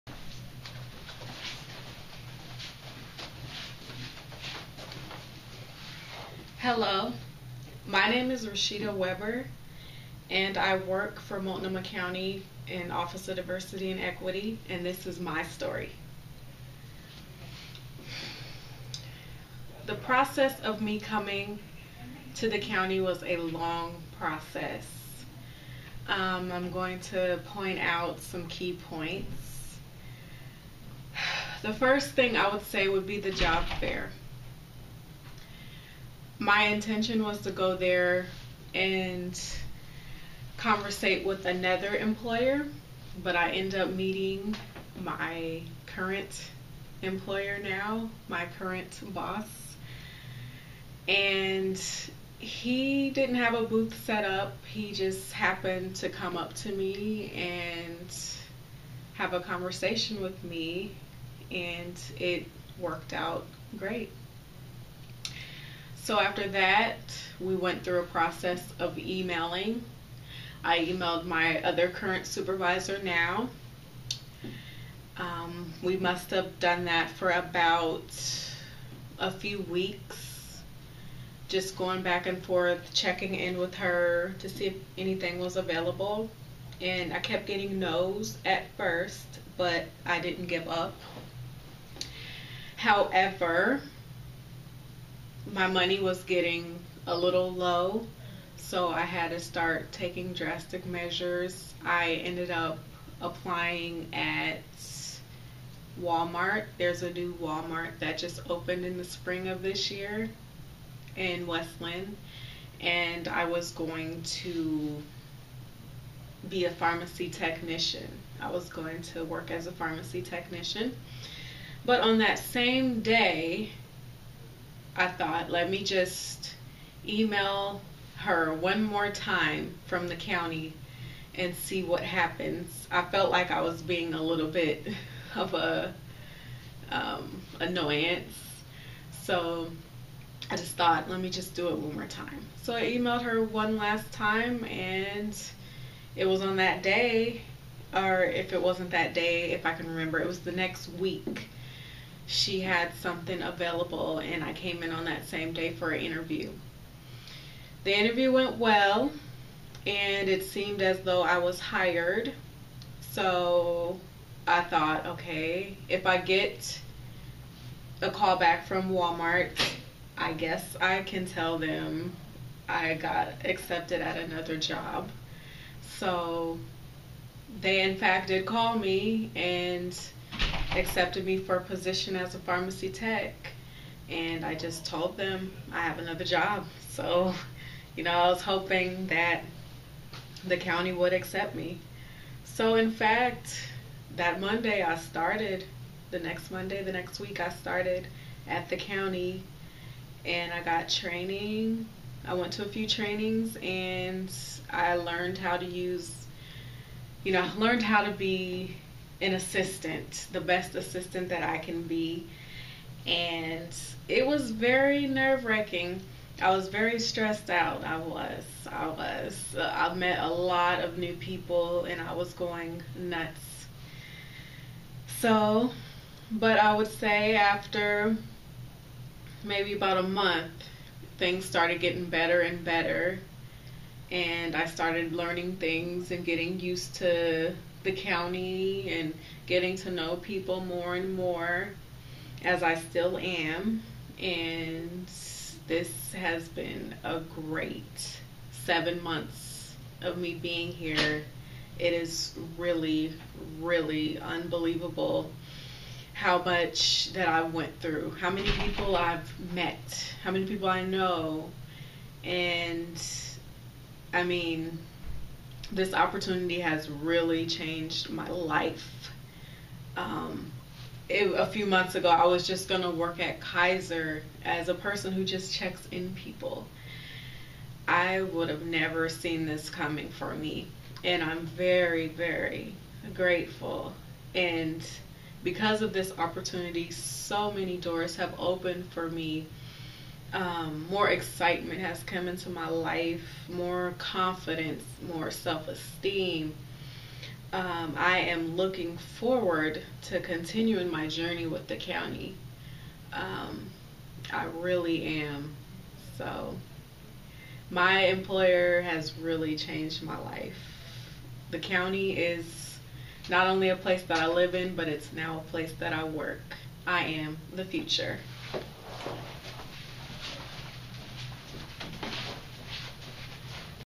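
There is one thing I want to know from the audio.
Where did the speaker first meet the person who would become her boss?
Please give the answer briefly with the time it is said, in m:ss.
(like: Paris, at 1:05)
Job fair, at 0:33.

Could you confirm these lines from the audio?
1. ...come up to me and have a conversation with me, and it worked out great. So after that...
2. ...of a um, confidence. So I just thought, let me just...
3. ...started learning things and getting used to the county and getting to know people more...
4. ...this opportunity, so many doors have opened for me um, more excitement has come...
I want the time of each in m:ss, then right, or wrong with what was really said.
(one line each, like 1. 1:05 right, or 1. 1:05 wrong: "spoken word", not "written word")
1. 0:56 right
2. 2:15 wrong: "annoyance", not "confidence"
3. 3:54 right
4. 4:45 right.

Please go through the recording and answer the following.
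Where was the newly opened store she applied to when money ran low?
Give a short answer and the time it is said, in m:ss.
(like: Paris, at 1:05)
Westland, at 1:51.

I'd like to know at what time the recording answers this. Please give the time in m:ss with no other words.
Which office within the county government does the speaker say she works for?
0:12.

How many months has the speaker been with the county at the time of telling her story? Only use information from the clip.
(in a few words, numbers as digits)
7.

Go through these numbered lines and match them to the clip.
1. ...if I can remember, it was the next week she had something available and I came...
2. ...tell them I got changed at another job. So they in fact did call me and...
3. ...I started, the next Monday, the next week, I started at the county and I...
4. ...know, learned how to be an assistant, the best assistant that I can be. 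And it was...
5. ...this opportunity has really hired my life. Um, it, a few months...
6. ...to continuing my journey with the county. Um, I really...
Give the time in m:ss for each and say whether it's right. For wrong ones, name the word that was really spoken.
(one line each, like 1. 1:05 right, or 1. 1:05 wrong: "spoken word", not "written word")
1. 2:29 right
2. 2:51 wrong: "accepted", not "changed"
3. 3:14 right
4. 3:27 right
5. 4:25 wrong: "changed", not "hired"
6. 5:00 right.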